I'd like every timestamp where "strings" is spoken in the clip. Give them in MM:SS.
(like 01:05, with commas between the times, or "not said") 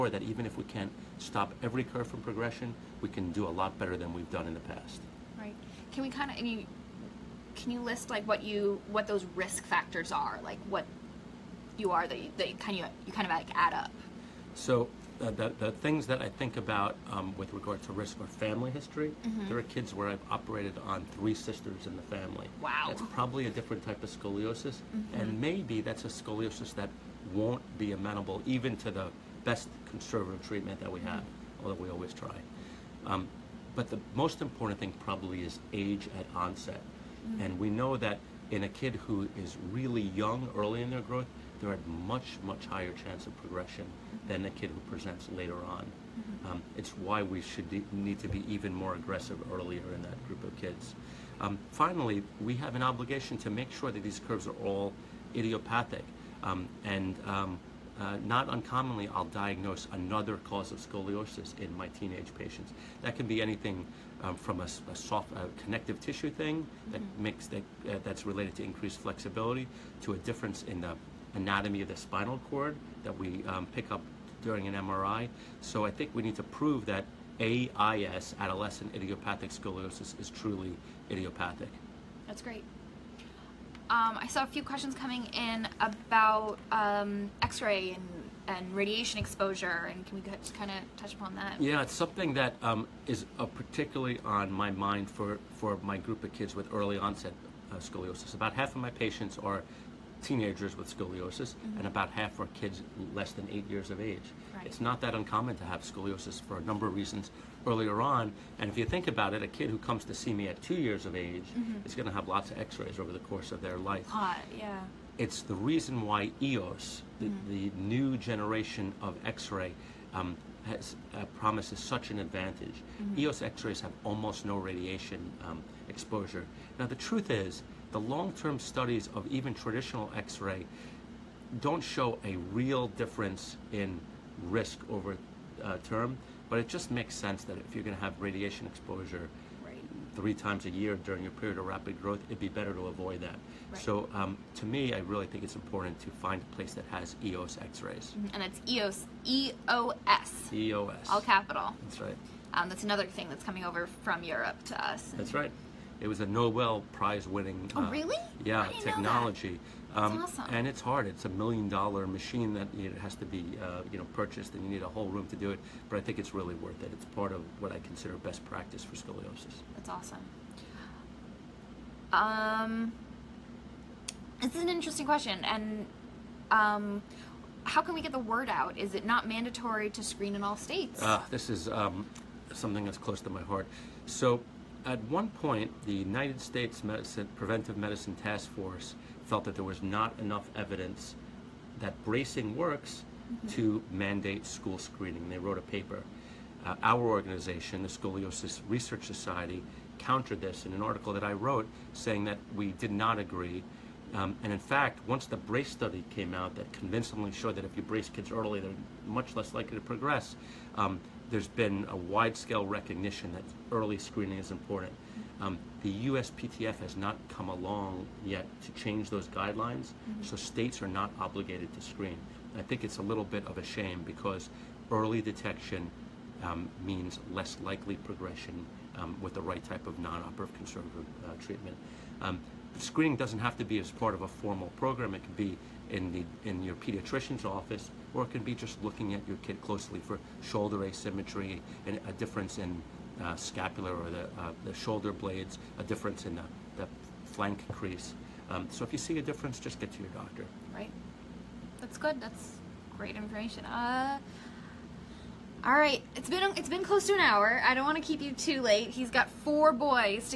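not said.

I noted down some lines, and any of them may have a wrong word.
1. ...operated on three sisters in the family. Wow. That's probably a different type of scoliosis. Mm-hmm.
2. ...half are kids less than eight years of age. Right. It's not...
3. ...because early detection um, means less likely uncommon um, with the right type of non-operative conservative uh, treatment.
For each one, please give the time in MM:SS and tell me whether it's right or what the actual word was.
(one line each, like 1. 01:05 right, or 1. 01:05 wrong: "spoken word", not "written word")
1. 00:20 right
2. 01:42 right
3. 03:44 wrong: "progression", not "uncommon".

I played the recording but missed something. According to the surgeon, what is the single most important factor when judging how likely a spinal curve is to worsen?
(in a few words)
Age at onset.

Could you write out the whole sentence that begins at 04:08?
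Um, so if you see a difference, just get to your doctor.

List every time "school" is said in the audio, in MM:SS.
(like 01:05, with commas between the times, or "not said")
03:14.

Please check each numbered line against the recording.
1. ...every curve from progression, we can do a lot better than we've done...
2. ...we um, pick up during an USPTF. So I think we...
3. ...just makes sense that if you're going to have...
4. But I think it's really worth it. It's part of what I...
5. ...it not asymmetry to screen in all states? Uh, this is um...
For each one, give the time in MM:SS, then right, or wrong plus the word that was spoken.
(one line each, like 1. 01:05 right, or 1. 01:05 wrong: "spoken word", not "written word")
1. 00:01 right
2. 01:13 wrong: "MRI", not "USPTF"
3. 02:16 right
4. 02:45 right
5. 02:58 wrong: "mandatory", not "asymmetry".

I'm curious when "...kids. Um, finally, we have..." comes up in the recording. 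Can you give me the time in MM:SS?
00:50.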